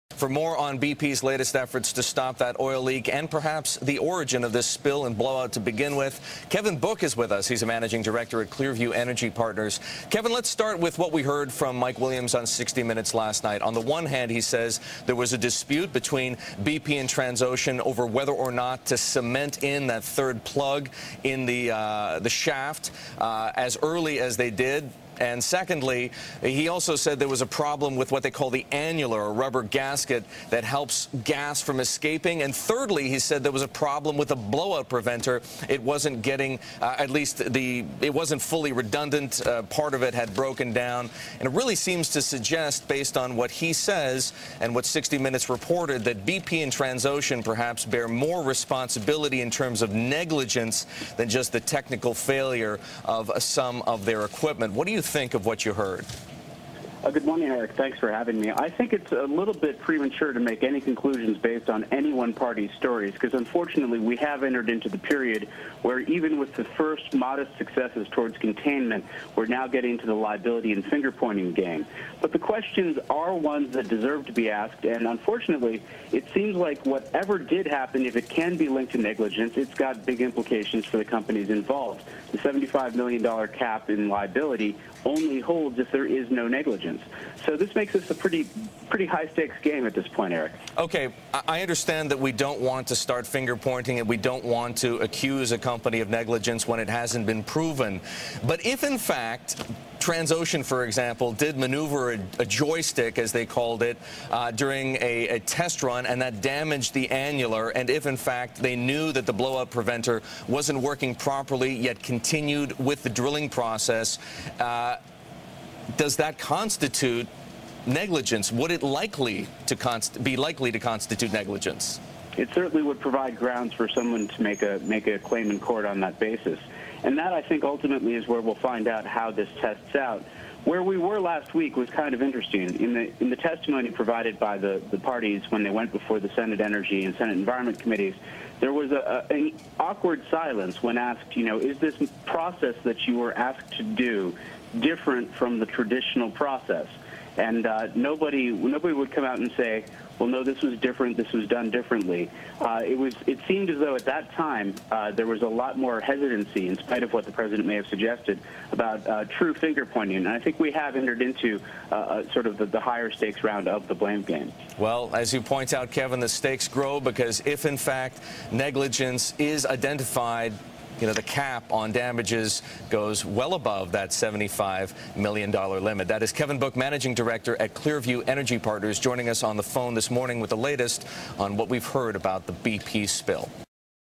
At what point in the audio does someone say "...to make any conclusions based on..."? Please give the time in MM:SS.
01:00.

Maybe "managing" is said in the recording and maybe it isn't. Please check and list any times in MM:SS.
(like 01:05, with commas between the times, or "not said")
00:07, 02:56.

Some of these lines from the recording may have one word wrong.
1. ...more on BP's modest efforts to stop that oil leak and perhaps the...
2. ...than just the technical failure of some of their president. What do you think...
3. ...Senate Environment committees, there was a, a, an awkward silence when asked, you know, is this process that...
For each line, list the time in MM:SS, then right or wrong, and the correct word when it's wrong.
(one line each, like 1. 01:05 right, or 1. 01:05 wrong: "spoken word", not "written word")
1. 00:00 wrong: "latest", not "modest"
2. 00:51 wrong: "equipment", not "president"
3. 02:17 right.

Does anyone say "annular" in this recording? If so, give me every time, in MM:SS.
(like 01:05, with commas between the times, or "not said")
00:28, 01:47.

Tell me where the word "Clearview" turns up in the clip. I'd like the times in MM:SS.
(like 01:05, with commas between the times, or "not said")
00:08, 02:57.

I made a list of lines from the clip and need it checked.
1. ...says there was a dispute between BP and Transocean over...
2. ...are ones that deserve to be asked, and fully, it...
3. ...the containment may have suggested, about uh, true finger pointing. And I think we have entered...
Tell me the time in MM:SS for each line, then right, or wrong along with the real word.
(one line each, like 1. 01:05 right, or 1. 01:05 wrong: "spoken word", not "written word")
1. 00:14 right
2. 01:13 wrong: "unfortunately", not "fully"
3. 02:37 wrong: "president", not "containment".